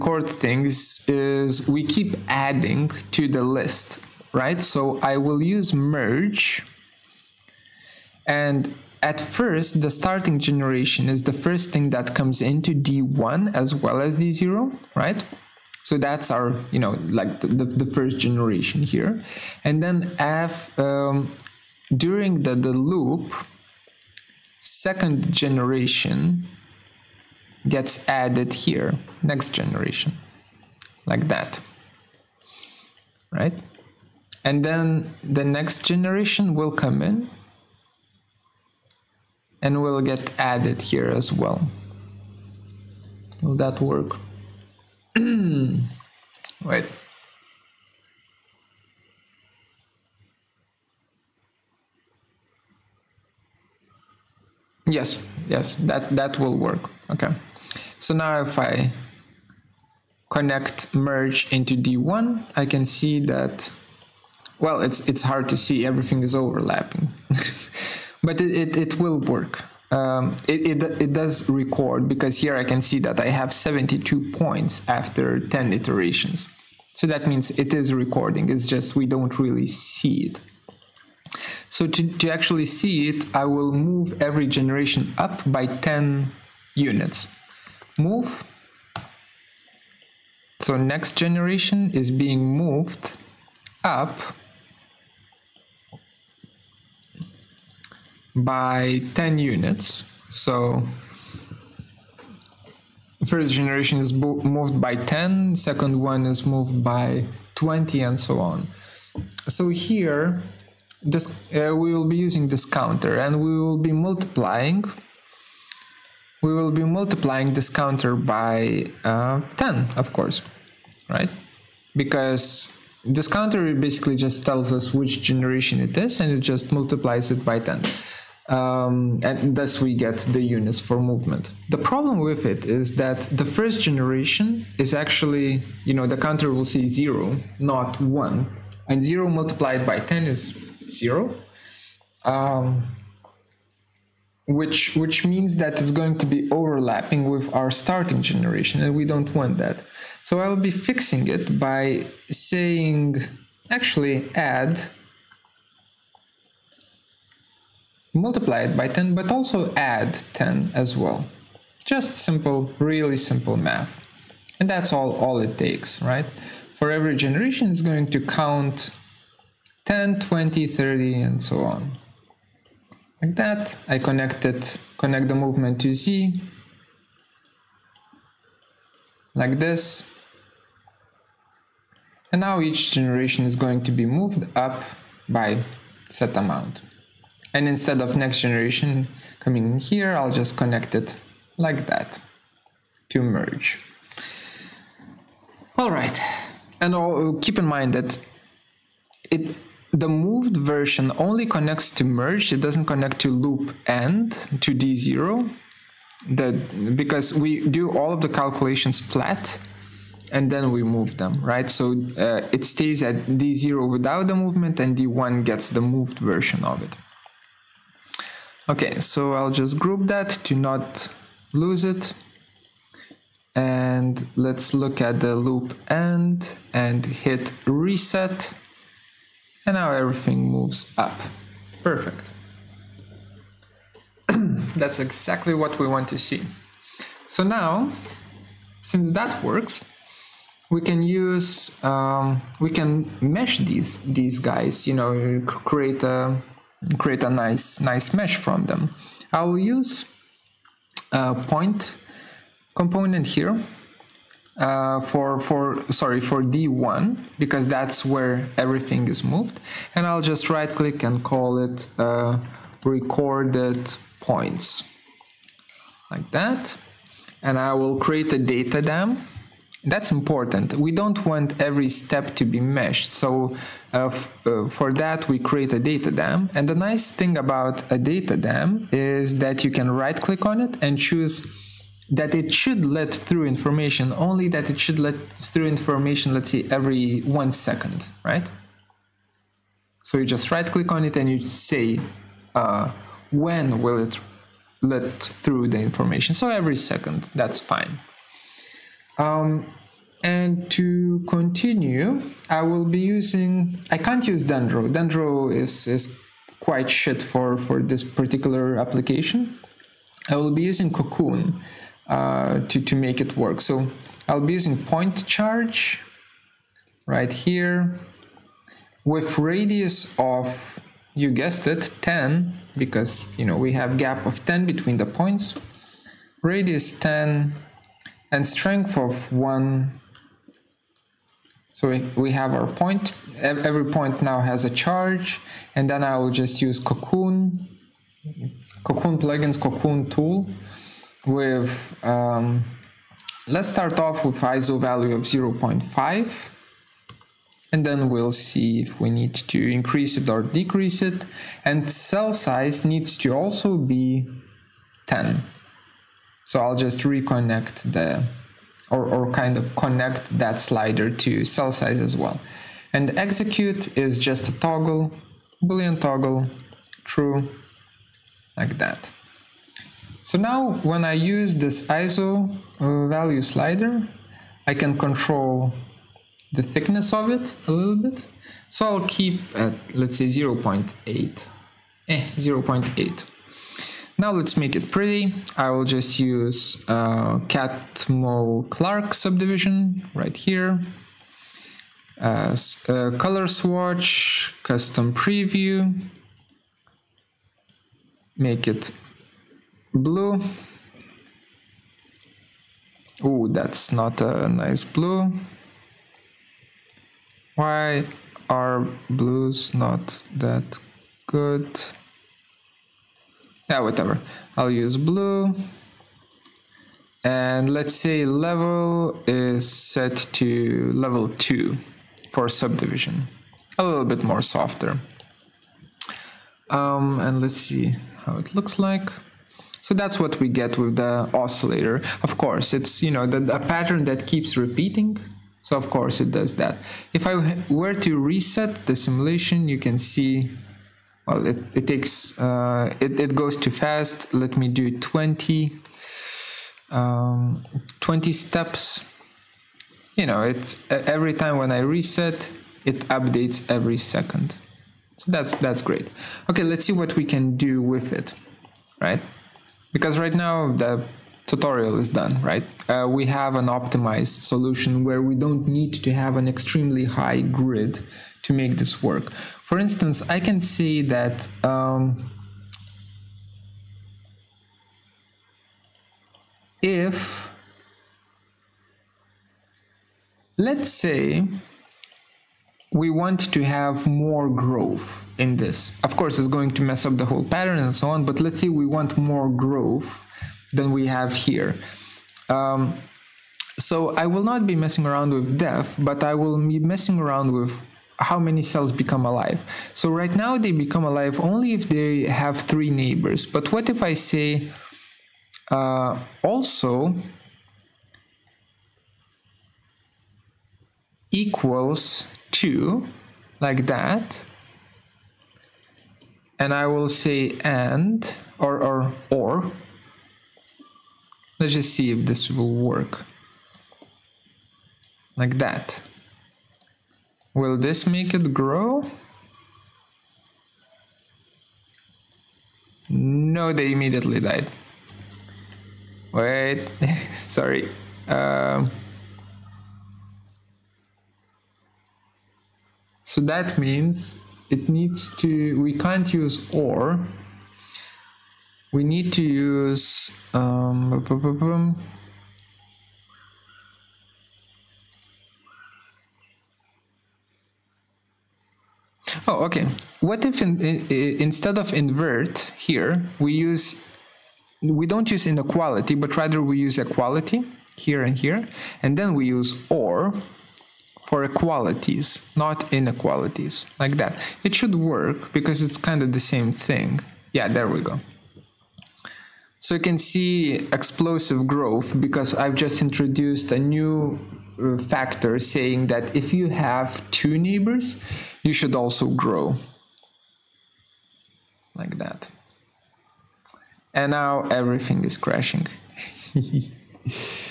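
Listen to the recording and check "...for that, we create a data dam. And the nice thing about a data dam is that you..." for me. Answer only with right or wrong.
right.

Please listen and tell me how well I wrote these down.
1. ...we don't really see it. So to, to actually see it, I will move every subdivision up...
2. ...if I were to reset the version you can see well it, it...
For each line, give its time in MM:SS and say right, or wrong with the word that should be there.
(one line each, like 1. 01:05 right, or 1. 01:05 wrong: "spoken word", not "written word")
1. 01:18 wrong: "generation", not "subdivision"
2. 07:17 wrong: "simulation", not "version".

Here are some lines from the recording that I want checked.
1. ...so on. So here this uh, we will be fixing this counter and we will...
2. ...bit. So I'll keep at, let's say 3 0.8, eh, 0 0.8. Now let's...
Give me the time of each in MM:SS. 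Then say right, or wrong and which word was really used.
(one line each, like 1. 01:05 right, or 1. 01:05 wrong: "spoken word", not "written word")
1. 01:48 wrong: "using", not "fixing"
2. 06:17 wrong: "0", not "3".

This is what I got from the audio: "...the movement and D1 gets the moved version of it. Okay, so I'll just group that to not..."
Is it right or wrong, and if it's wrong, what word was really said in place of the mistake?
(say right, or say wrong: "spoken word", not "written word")
right.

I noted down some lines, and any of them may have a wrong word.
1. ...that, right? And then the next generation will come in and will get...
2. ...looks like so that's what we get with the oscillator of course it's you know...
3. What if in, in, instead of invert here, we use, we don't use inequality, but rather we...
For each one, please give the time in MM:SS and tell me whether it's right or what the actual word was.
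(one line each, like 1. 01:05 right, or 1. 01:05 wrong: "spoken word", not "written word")
1. 00:31 right
2. 07:08 right
3. 09:20 right.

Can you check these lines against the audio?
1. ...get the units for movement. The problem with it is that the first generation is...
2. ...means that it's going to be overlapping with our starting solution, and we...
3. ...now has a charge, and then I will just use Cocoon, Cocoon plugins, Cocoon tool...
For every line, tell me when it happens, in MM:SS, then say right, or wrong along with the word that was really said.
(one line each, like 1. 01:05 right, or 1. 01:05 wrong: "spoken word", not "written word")
1. 02:09 right
2. 02:25 wrong: "generation", not "solution"
3. 05:34 right.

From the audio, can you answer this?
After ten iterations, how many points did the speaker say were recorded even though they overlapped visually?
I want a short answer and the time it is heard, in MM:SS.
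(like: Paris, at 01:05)
72, at 01:13.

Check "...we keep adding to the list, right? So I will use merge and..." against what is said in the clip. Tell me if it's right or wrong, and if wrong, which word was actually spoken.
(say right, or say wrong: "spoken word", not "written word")
right.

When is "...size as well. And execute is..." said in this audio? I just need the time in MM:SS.
06:01.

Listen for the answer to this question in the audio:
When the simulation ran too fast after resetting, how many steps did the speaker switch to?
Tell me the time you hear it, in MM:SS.
07:27.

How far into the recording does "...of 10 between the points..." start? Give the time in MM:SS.
05:24.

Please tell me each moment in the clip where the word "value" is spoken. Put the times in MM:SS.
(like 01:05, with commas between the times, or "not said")
05:44, 06:13.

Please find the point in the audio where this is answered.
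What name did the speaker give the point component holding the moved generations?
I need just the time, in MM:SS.
04:22.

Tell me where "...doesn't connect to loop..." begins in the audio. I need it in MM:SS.
03:22.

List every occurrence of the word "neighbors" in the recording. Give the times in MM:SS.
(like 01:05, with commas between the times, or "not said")
08:22, 09:47.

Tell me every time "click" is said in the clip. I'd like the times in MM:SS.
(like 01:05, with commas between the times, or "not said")
04:20, 04:40, 04:50.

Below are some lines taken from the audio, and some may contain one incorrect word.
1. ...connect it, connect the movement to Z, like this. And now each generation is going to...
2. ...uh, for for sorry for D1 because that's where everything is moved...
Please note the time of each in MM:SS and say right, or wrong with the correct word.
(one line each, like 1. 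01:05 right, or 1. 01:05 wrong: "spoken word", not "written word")
1. 02:53 right
2. 04:14 right.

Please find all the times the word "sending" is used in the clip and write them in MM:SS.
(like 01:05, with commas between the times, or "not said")
not said.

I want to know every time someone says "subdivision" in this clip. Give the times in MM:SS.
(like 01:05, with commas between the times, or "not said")
06:29, 07:02.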